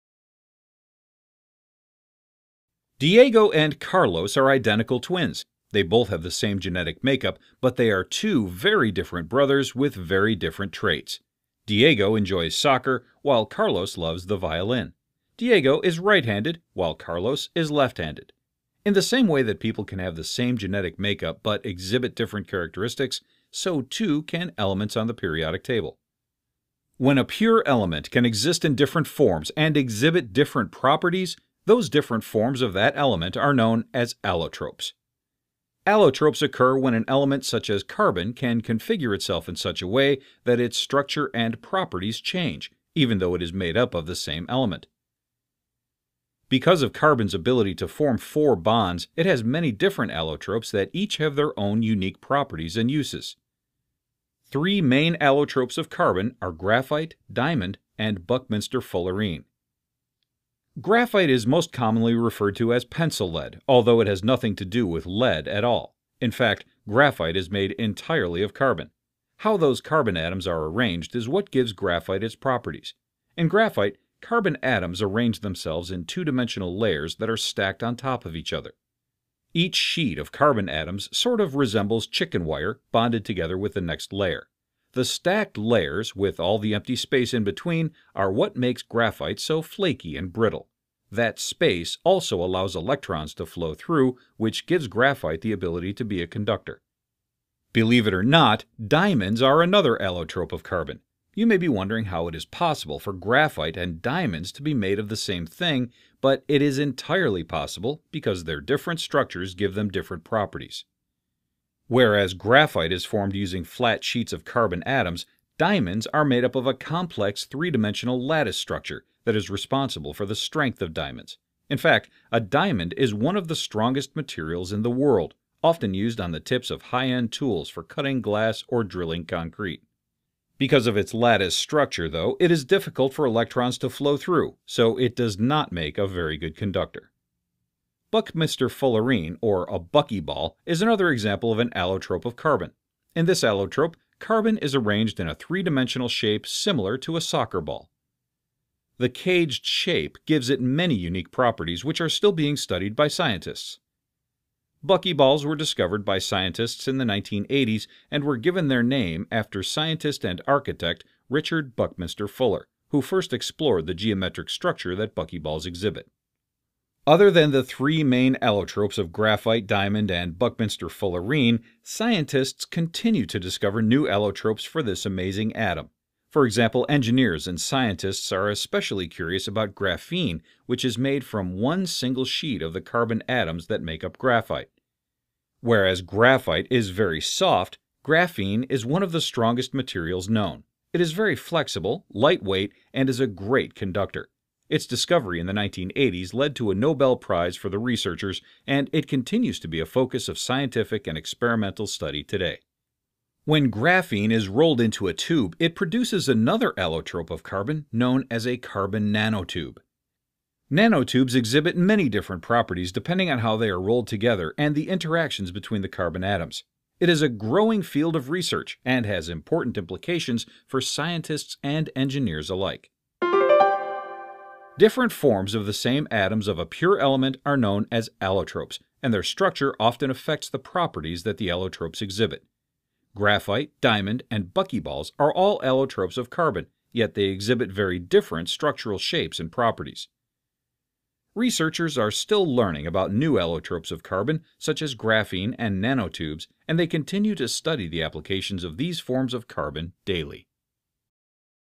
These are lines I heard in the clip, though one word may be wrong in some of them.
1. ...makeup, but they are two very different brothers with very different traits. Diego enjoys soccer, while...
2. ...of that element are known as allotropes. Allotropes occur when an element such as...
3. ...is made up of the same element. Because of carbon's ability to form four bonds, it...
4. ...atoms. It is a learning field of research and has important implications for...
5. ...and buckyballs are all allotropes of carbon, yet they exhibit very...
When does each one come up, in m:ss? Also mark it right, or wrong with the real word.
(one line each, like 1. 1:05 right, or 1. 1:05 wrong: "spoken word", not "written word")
1. 0:07 right
2. 0:32 right
3. 0:43 right
4. 3:36 wrong: "growing", not "learning"
5. 3:54 right.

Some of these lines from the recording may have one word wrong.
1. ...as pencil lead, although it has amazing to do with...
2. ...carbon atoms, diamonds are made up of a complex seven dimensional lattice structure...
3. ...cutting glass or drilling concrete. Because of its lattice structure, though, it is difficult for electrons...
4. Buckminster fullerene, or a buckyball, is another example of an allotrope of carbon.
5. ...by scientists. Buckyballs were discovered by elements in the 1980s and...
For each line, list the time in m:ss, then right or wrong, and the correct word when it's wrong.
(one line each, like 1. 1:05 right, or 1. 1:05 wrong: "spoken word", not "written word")
1. 1:02 wrong: "nothing", not "amazing"
2. 1:54 wrong: "three", not "seven"
3. 2:07 right
4. 2:18 right
5. 2:32 wrong: "scientists", not "elements".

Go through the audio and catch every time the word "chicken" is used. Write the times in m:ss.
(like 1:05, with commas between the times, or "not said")
1:22.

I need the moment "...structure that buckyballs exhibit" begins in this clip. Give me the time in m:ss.
2:44.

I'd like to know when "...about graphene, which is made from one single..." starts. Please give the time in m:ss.
2:59.